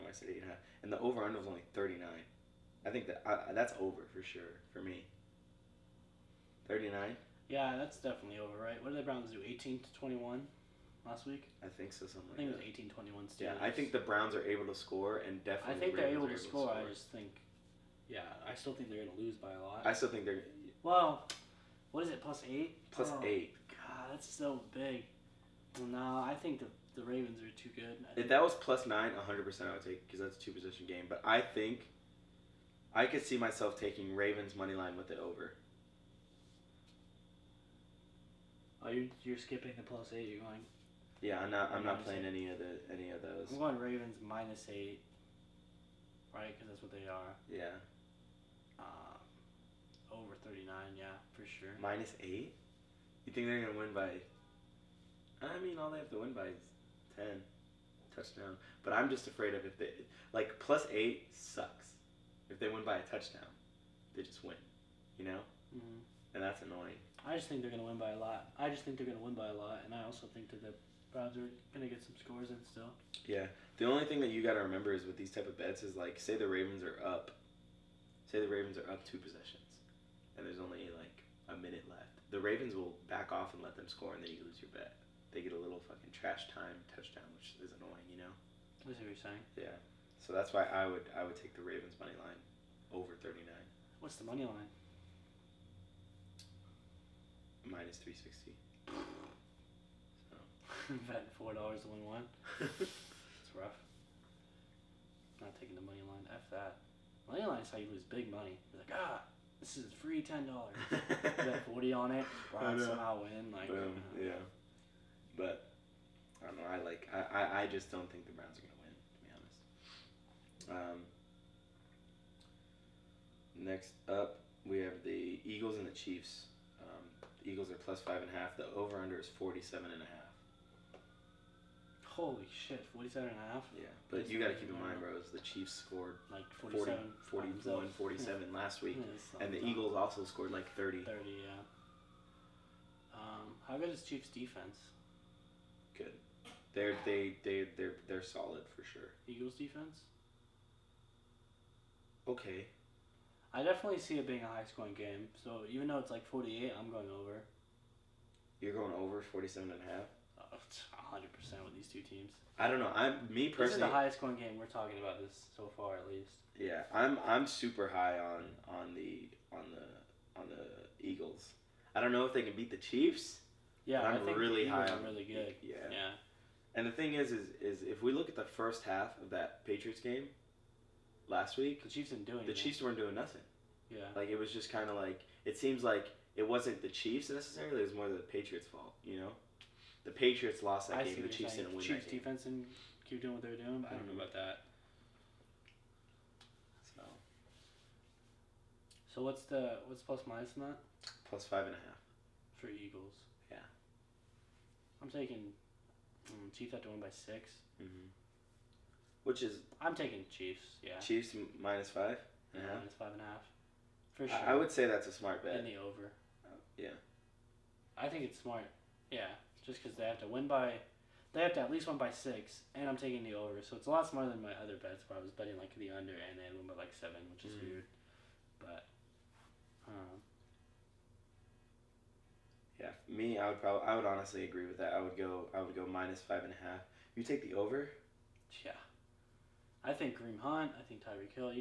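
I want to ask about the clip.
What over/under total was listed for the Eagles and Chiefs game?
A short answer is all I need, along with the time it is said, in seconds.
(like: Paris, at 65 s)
47.5, at 129 s.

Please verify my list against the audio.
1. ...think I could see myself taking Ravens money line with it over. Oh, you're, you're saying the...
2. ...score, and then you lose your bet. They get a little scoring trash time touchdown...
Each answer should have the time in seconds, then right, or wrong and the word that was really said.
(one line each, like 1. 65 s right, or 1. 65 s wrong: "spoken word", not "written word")
1. 31 s wrong: "skipping", not "saying"
2. 83 s wrong: "fucking", not "scoring".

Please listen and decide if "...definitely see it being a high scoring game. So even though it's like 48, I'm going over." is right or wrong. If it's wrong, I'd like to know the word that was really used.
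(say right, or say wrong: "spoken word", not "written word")
right.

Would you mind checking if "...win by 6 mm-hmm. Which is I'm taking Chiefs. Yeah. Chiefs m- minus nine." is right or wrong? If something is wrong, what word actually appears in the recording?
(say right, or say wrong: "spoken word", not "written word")
wrong: "five", not "nine".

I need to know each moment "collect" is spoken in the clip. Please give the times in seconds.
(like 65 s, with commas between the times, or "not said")
not said.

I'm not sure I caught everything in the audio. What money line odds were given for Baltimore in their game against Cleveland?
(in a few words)
-360.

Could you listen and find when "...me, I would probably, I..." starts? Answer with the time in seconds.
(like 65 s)
233 s.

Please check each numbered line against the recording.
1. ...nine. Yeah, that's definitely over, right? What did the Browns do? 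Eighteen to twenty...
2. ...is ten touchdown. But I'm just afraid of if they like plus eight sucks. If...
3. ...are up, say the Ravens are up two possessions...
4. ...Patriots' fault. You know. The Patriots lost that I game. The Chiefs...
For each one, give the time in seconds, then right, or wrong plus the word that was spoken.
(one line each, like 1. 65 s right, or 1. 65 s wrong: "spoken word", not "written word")
1. 6 s right
2. 56 s right
3. 76 s right
4. 188 s right.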